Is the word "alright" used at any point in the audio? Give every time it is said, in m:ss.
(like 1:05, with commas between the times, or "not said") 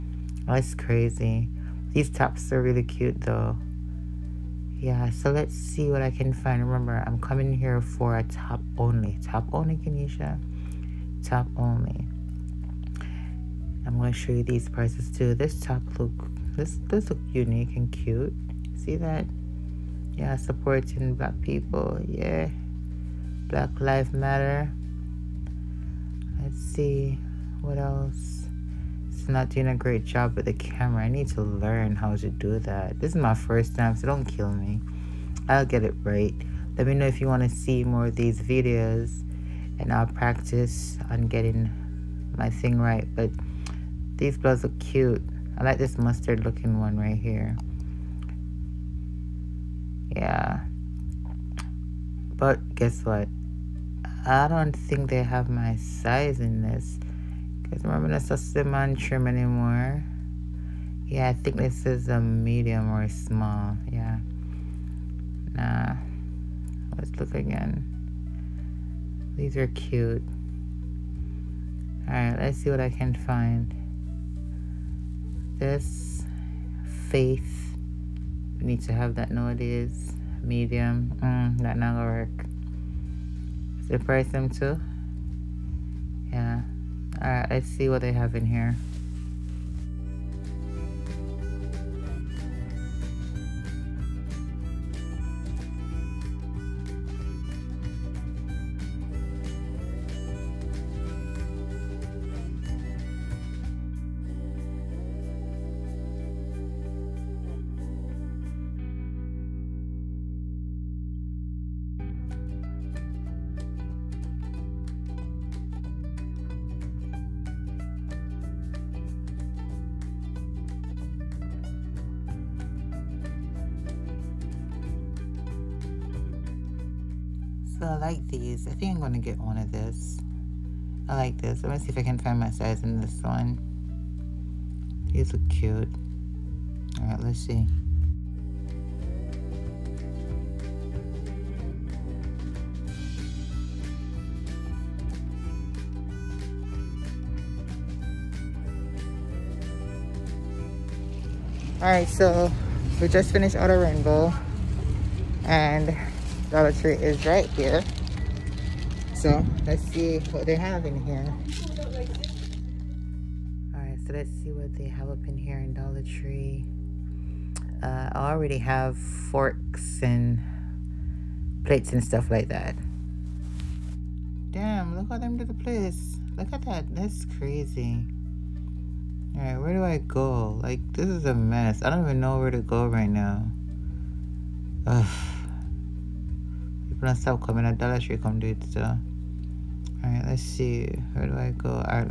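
1:12, 1:27, 2:59, 3:10.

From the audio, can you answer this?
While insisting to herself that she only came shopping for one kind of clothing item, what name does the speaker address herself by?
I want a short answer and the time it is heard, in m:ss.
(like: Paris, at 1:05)
Keneisha, at 0:09.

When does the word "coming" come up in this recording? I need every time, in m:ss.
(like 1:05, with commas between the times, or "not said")
0:07, 3:07.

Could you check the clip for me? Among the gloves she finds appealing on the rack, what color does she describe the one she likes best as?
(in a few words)
Mustard.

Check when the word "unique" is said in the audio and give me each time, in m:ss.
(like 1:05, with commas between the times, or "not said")
0:17.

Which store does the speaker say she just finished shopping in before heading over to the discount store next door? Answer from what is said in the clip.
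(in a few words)
Rainbow.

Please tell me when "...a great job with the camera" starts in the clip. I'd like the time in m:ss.
0:29.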